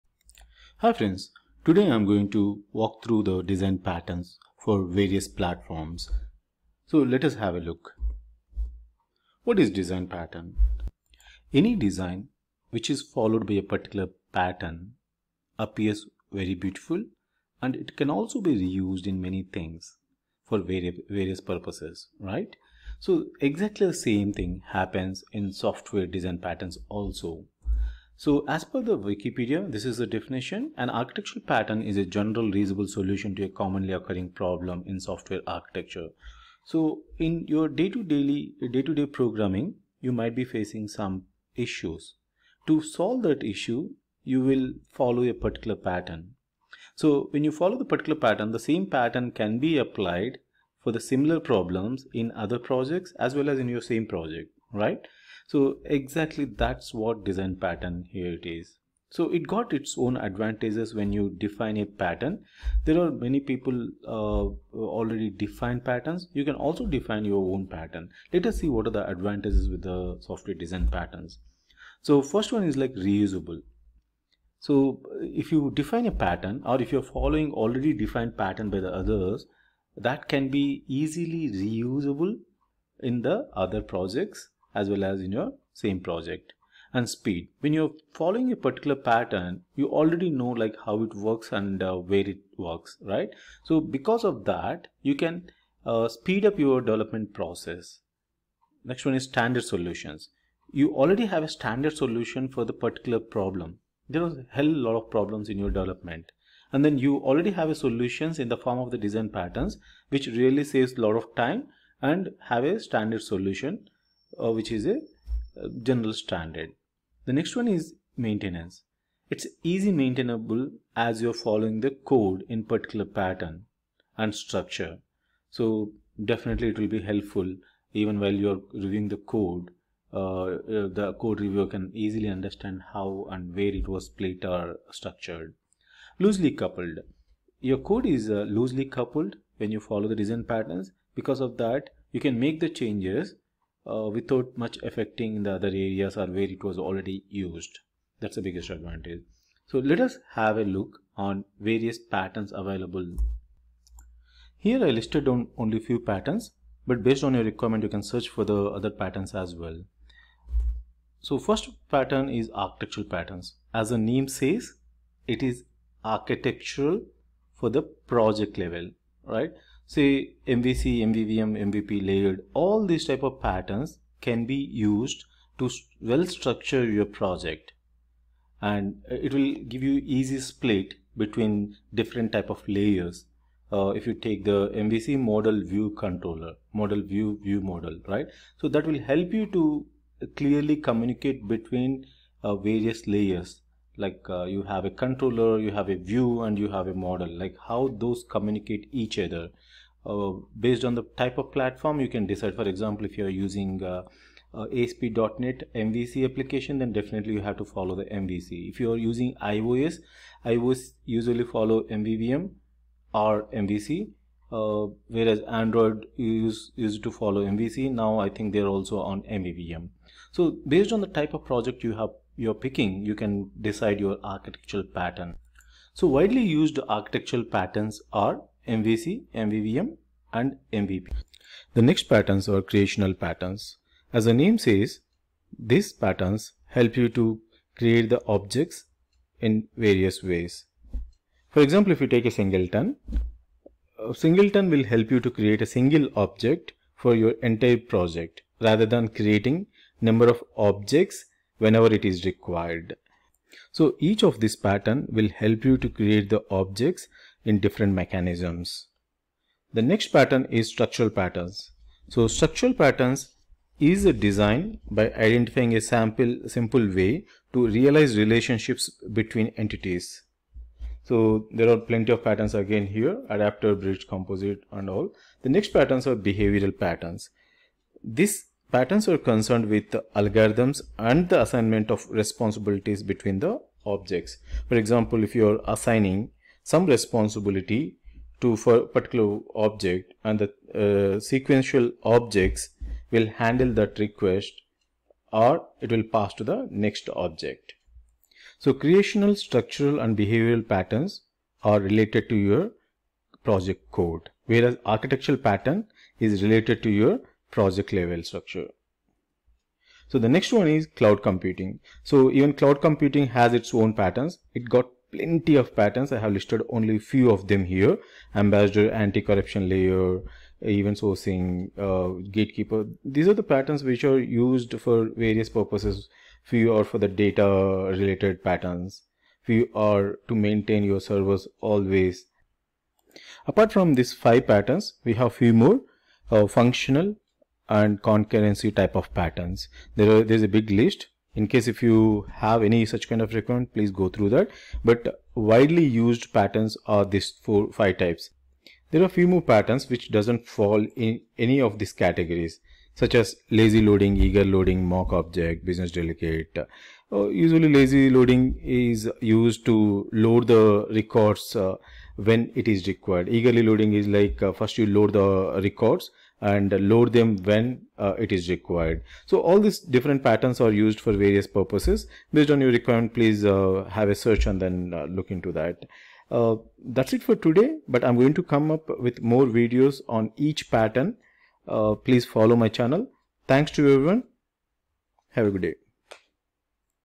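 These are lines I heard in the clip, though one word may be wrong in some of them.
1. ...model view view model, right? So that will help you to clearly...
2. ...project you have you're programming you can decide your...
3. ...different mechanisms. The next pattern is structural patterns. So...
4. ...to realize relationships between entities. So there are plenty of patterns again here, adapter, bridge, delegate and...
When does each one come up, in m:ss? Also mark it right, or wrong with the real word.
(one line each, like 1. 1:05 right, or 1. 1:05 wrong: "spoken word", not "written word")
1. 3:06 right
2. 3:41 wrong: "picking", not "programming"
3. 4:17 right
4. 4:27 wrong: "composite", not "delegate".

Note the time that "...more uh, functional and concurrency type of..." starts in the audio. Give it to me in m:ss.
5:35.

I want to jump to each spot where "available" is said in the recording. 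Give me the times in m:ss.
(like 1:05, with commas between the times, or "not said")
2:32.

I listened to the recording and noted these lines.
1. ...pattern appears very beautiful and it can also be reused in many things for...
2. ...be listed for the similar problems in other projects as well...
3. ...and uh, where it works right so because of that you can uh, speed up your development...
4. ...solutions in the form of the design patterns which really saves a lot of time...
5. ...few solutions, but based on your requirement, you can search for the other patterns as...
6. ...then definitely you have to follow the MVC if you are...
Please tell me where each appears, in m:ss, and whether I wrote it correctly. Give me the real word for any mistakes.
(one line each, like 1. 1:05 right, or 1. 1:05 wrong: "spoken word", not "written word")
1. 0:14 right
2. 0:49 wrong: "applied", not "listed"
3. 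1:31 right
4. 1:47 right
5. 2:35 wrong: "patterns", not "solutions"
6. 3:26 right.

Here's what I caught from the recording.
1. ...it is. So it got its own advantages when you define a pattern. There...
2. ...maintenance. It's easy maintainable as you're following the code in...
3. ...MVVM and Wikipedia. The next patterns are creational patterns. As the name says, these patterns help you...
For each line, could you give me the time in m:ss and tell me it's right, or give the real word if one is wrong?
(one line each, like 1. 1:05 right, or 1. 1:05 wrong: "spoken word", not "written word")
1. 0:58 right
2. 1:58 right
3. 3:49 wrong: "MVP", not "Wikipedia".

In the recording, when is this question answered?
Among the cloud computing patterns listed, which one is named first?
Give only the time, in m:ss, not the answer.
5:18.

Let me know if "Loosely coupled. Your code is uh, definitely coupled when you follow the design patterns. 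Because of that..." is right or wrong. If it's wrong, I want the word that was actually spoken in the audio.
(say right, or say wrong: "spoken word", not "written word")
wrong: "loosely", not "definitely".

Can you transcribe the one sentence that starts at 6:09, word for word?
So all these different patterns are used for various purposes.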